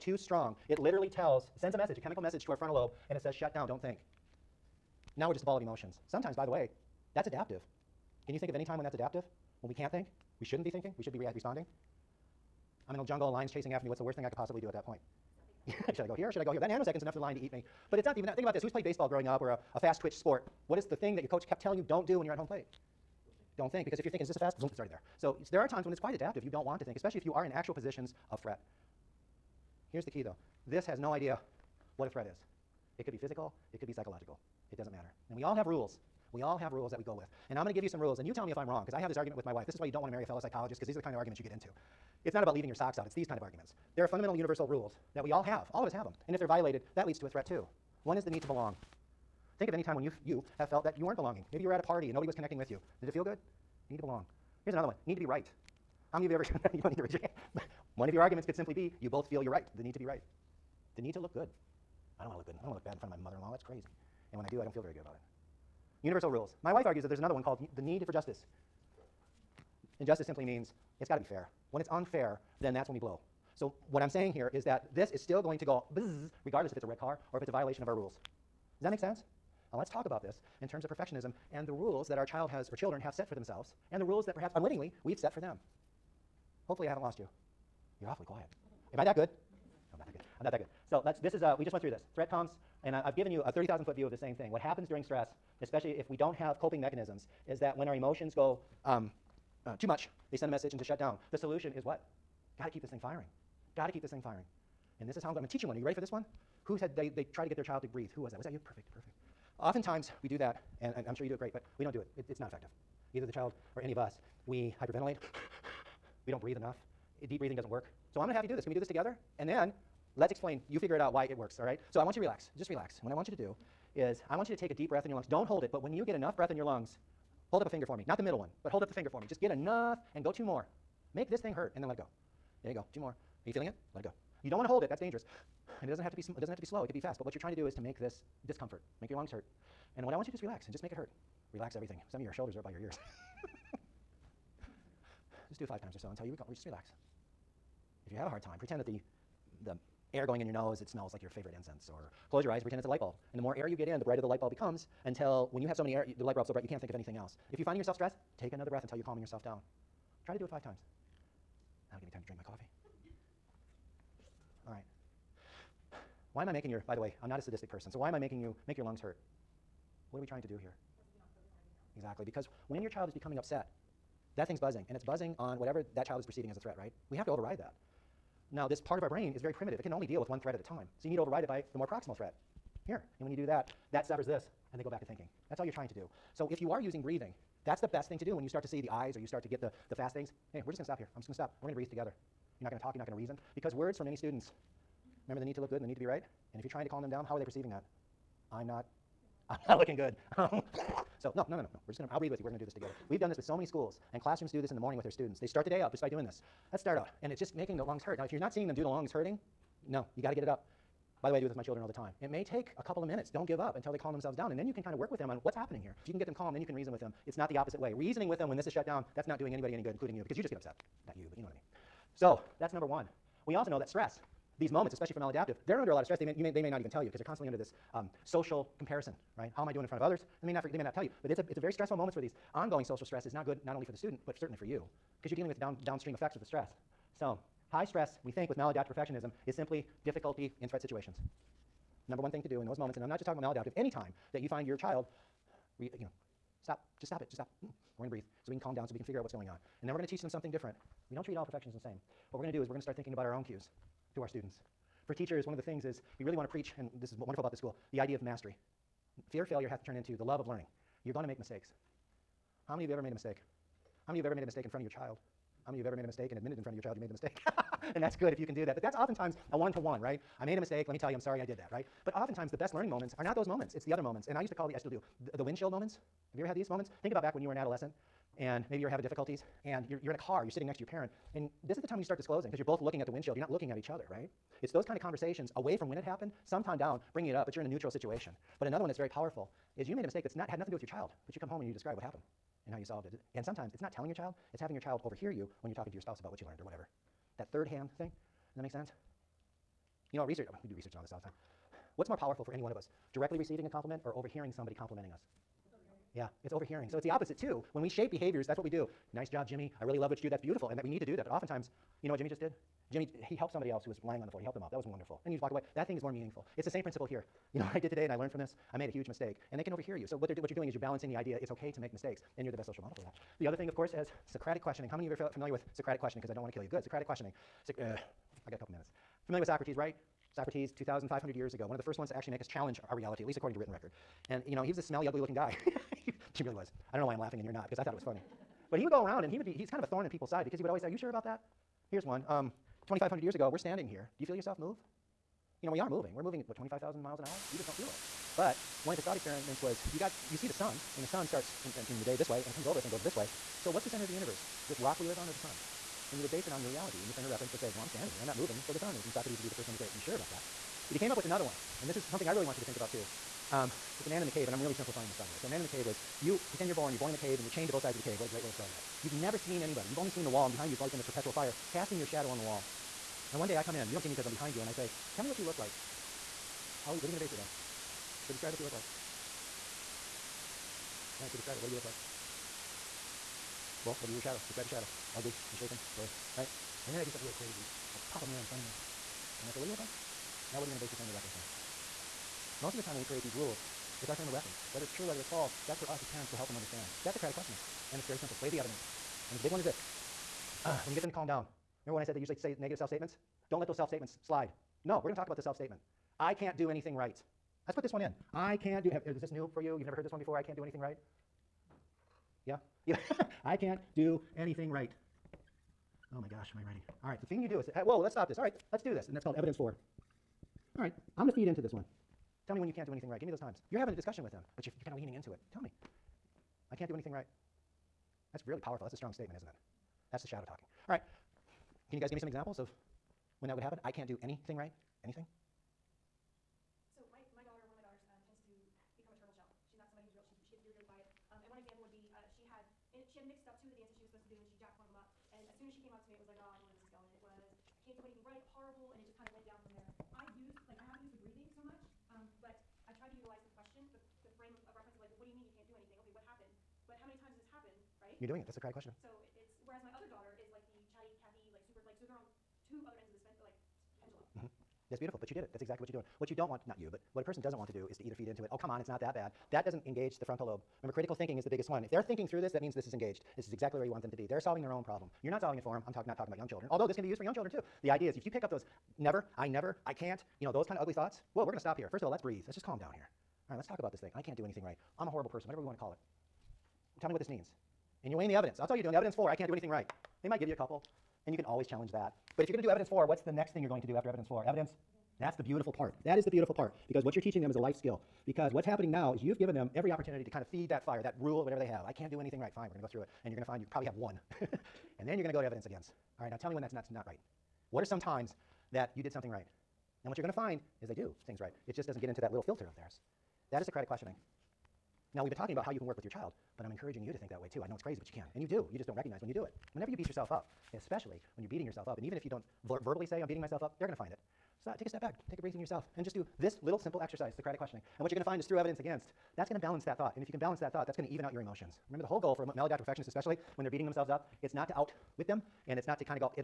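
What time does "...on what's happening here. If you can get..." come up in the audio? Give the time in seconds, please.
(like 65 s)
215 s.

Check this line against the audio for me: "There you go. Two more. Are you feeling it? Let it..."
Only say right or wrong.
right.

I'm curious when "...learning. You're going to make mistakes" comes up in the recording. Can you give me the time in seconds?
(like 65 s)
260 s.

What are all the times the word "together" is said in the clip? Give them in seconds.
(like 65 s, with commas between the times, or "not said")
118 s, 191 s, 202 s.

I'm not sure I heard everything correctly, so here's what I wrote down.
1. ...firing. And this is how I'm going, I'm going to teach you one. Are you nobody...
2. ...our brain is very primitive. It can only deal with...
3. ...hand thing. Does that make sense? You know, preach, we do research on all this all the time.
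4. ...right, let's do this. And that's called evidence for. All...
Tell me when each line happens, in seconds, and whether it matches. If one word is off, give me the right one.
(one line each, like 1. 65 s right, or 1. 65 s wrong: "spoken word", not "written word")
1. 104 s wrong: "ready", not "nobody"
2. 179 s right
3. 297 s wrong: "research", not "preach"
4. 418 s right.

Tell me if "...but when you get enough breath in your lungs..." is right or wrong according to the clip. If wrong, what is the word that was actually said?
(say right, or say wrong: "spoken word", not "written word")
right.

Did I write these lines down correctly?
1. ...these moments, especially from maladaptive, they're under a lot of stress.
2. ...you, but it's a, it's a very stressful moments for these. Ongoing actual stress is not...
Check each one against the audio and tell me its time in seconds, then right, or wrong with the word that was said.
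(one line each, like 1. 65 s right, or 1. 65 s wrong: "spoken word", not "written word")
1. 224 s right
2. 231 s wrong: "social", not "actual".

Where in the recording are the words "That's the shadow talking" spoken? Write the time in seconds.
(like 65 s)
430 s.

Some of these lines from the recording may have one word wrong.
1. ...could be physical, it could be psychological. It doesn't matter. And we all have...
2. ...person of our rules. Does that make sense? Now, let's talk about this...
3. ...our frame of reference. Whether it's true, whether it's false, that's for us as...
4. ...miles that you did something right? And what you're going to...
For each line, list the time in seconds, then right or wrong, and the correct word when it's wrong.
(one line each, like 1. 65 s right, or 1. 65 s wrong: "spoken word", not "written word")
1. 33 s right
2. 77 s wrong: "violation", not "person"
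3. 394 s right
4. 507 s wrong: "times", not "miles".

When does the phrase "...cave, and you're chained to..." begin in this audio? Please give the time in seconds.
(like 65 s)
367 s.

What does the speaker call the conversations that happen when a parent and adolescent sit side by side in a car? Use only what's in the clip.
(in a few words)
Windshield moments.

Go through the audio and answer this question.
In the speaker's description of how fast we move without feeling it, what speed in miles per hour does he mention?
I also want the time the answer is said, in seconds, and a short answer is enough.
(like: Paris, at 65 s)
25,000, at 346 s.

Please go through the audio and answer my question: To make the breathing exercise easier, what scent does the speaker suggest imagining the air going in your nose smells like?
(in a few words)
Favorite incense.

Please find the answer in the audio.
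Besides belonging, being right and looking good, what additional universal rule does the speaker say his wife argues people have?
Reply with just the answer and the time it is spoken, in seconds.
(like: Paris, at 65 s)
Need for justice, at 67 s.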